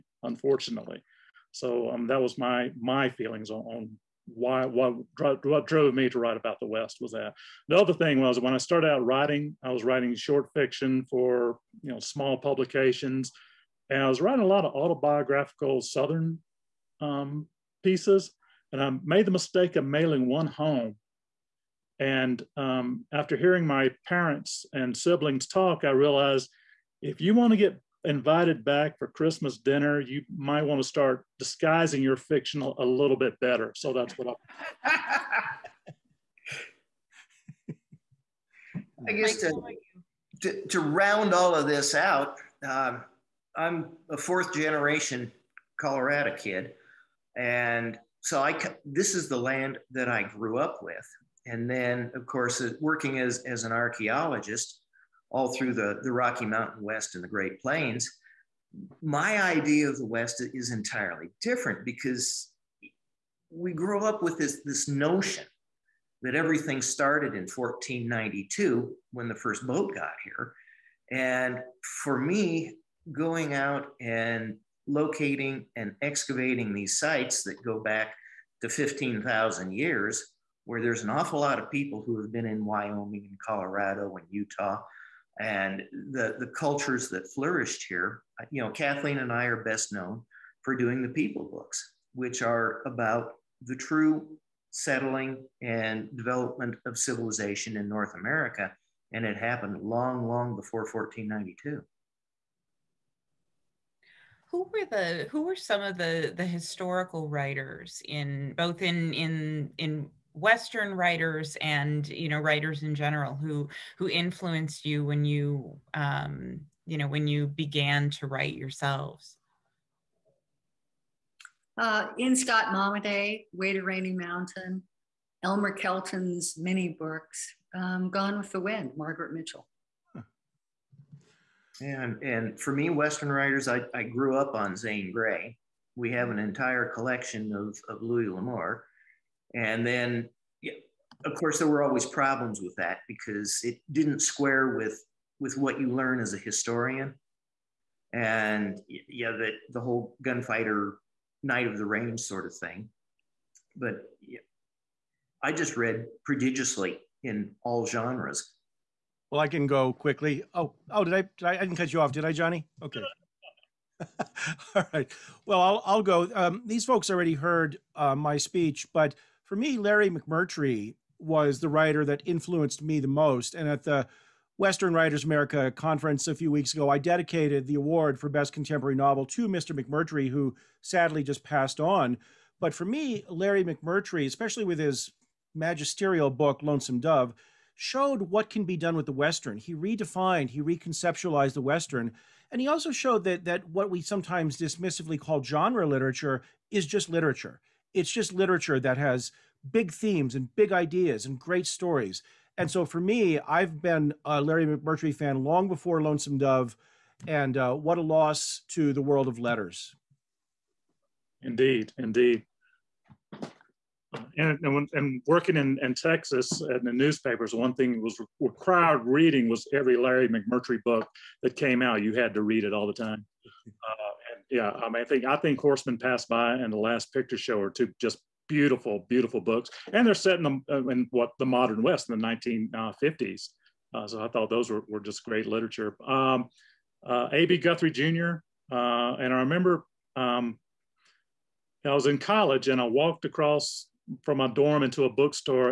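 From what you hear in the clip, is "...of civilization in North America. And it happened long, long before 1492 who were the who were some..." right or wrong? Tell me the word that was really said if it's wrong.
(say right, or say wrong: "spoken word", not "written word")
right.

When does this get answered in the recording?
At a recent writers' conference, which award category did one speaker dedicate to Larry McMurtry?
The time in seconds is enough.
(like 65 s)
178 s.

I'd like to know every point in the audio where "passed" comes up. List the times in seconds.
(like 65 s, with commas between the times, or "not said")
181 s, 225 s.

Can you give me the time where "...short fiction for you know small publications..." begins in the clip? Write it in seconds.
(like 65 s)
10 s.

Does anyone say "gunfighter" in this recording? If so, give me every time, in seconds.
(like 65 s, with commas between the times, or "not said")
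150 s.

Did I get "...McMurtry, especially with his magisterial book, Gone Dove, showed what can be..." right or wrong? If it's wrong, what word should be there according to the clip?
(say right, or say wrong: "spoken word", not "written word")
wrong: "Lonesome", not "Gone".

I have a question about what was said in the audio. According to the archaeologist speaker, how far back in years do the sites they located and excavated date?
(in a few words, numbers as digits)
15,000 years.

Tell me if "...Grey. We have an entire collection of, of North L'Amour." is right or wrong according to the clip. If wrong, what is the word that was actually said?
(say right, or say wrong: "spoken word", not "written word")
wrong: "Louis", not "North".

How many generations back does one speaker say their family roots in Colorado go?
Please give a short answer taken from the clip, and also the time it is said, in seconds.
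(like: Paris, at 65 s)
4, at 44 s.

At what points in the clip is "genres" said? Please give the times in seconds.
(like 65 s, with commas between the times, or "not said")
157 s, 195 s.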